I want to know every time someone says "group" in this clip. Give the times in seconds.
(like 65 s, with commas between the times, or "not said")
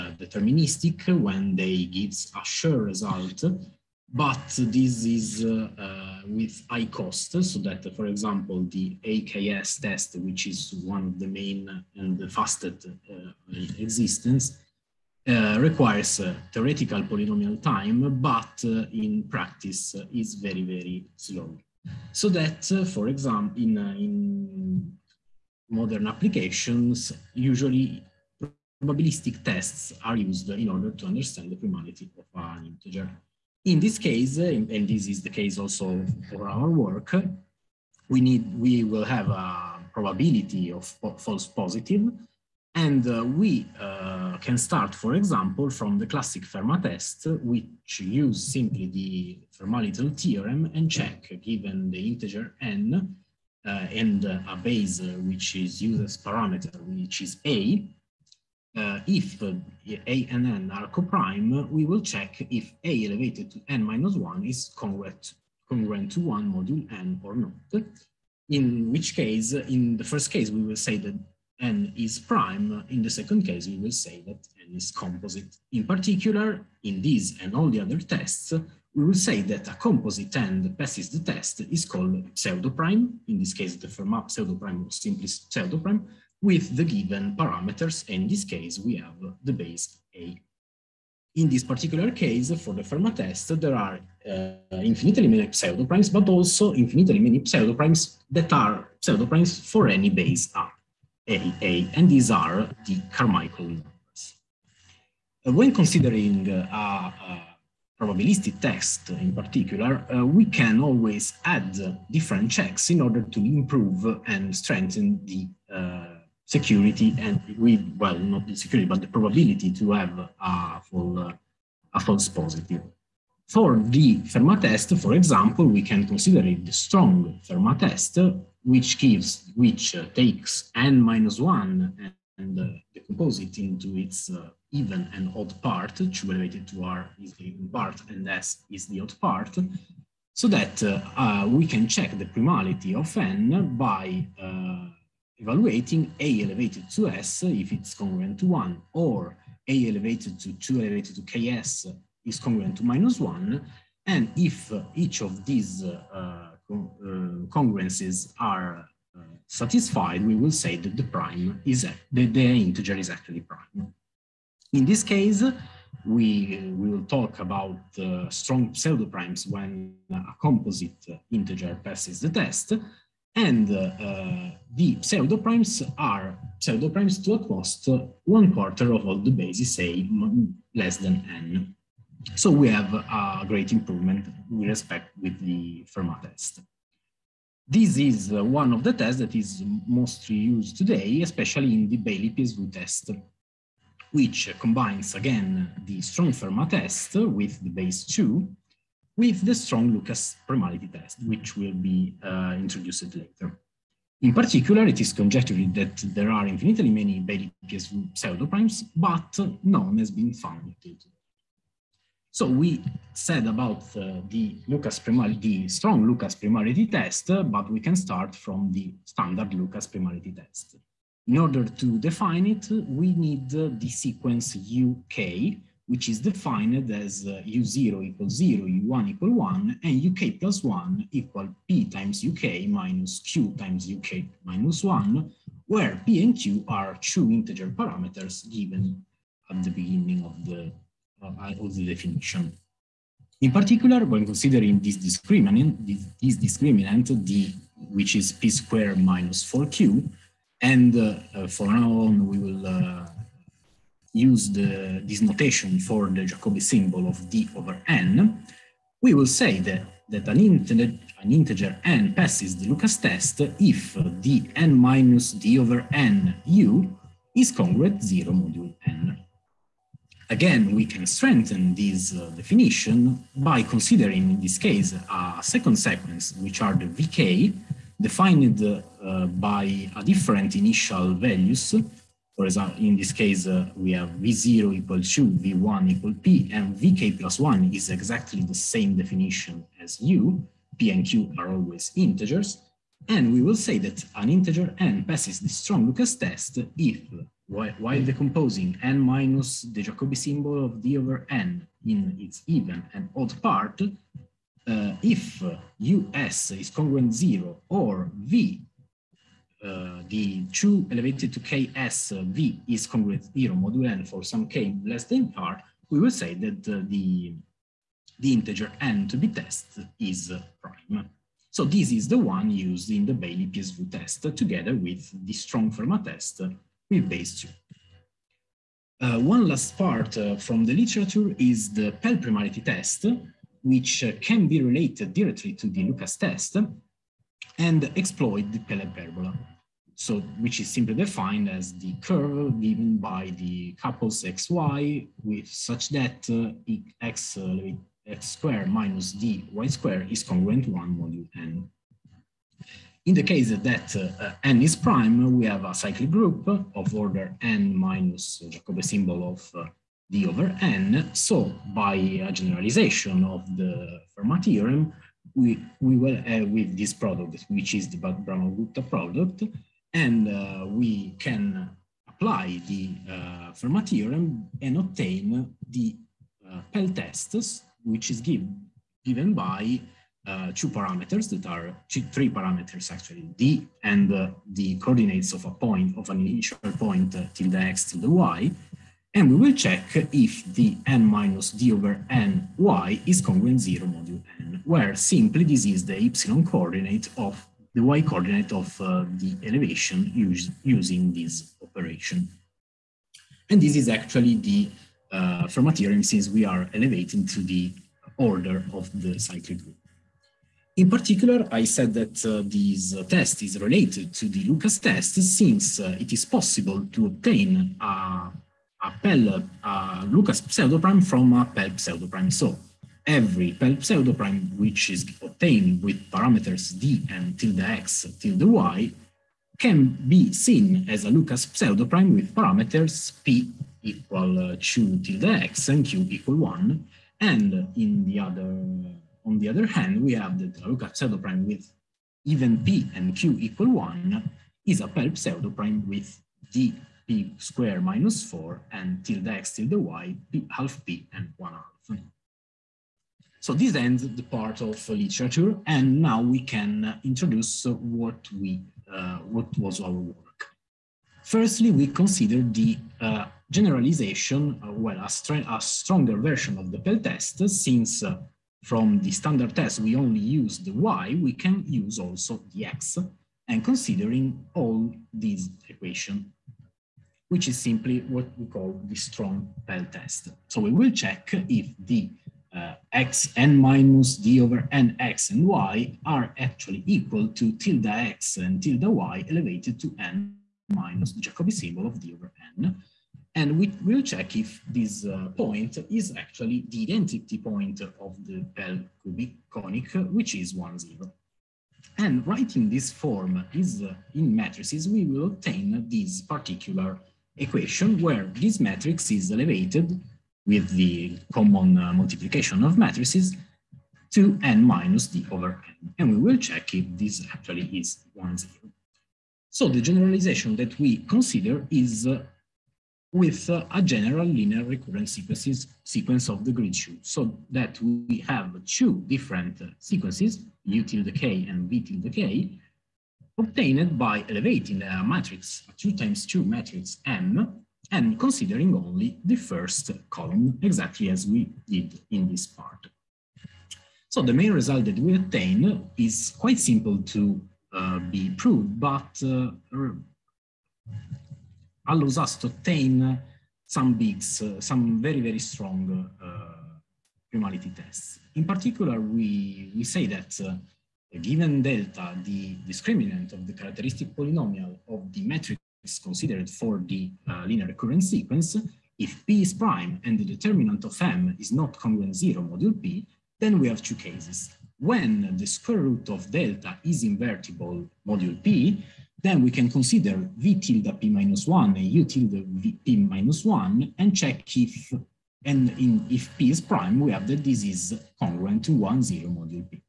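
356 s, 409 s.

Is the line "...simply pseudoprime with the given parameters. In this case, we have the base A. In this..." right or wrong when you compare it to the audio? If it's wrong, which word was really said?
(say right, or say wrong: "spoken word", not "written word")
right.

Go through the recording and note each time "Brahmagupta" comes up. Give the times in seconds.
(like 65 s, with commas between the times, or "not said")
367 s.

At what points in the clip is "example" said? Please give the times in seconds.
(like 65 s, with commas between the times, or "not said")
8 s, 23 s, 45 s, 125 s, 282 s.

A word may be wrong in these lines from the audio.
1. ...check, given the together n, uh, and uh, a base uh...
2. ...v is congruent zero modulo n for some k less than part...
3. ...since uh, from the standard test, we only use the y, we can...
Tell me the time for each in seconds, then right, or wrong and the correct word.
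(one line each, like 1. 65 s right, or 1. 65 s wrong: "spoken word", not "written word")
1. 50 s wrong: "integer", not "together"
2. 312 s right
3. 467 s right.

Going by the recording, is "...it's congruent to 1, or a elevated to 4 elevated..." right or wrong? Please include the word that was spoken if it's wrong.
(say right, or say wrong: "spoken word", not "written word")
wrong: "2", not "4".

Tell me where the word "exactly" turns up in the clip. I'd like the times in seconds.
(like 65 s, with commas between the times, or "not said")
287 s, 540 s.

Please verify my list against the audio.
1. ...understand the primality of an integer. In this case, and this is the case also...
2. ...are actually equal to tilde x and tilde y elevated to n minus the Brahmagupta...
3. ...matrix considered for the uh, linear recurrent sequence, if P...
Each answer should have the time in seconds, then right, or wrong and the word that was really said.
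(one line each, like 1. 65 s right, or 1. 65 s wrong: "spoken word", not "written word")
1. 31 s right
2. 486 s wrong: "Jacobi", not "Brahmagupta"
3. 565 s right.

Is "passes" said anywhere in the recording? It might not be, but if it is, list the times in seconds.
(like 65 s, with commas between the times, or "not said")
80 s, 171 s, 262 s, 295 s.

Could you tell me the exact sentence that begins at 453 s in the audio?
So this ends the part of literature and now we can introduce what we uh, what was our work.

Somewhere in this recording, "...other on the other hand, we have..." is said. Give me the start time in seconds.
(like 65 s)
438 s.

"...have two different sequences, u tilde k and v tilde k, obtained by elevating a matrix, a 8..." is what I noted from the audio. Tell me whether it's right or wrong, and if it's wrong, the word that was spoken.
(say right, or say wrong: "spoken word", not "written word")
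wrong: "2", not "8".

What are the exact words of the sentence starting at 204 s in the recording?
In particular, it is conjectured that there are infinitely many Baillie-PSW pseudoprimes, but none has been found today.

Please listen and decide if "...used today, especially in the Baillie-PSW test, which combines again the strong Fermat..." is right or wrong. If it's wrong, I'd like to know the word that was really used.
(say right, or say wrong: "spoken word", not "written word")
right.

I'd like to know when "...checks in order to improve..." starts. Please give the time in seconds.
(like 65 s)
112 s.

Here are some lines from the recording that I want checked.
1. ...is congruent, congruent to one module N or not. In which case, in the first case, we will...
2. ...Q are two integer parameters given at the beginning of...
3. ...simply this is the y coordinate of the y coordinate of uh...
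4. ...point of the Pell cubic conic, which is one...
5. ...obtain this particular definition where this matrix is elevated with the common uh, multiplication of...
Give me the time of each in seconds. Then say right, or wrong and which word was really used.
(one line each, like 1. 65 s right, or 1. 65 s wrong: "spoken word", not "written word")
1. 64 s right
2. 236 s right
3. 394 s right
4. 497 s right
5. 505 s wrong: "equation", not "definition".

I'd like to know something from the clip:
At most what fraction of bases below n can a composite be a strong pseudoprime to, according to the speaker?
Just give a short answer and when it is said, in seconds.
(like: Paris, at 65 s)
one quarter, at 178 s.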